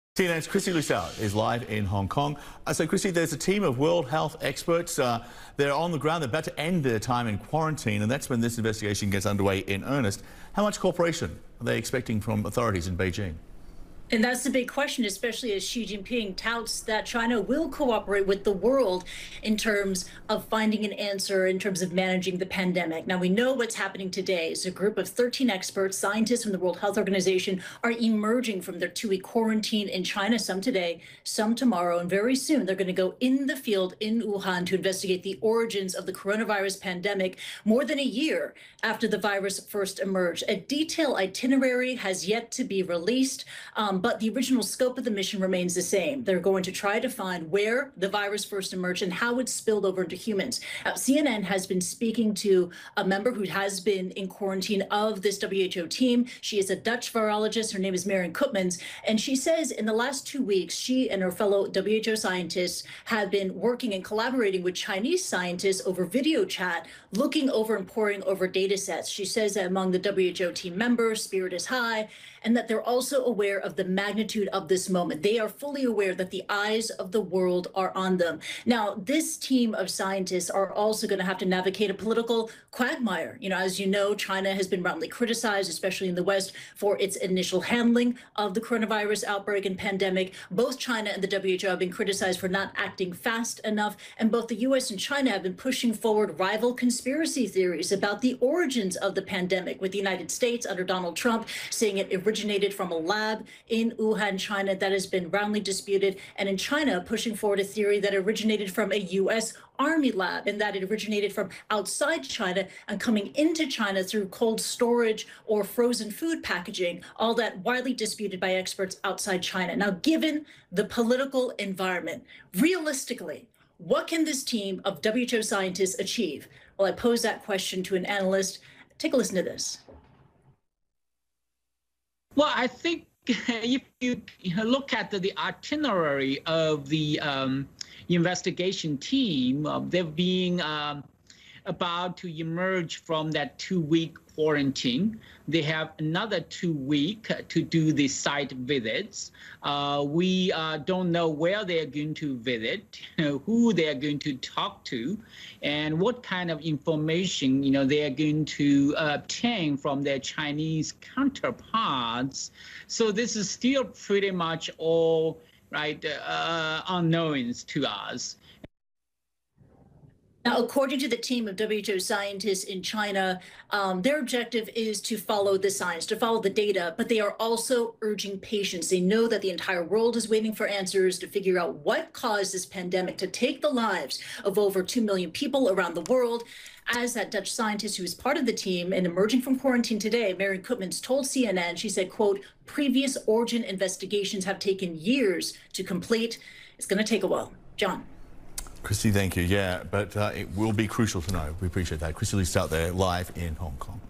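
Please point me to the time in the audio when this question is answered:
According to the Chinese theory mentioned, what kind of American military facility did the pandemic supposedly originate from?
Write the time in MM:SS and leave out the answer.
01:49.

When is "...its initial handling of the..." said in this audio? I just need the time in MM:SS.
01:26.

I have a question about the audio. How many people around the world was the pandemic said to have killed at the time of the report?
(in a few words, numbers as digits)
over 2 million.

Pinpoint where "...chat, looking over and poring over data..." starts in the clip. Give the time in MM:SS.
01:06.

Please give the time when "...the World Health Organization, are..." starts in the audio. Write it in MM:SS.
00:26.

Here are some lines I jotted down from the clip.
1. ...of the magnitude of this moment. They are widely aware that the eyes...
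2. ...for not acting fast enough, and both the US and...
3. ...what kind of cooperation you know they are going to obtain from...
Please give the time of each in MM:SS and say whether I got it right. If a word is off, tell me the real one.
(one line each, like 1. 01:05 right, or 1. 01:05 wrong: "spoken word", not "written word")
1. 01:13 wrong: "fully", not "widely"
2. 01:32 right
3. 02:35 wrong: "information", not "cooperation".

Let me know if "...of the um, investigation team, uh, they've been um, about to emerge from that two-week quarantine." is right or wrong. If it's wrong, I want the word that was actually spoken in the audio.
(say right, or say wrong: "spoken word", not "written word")
right.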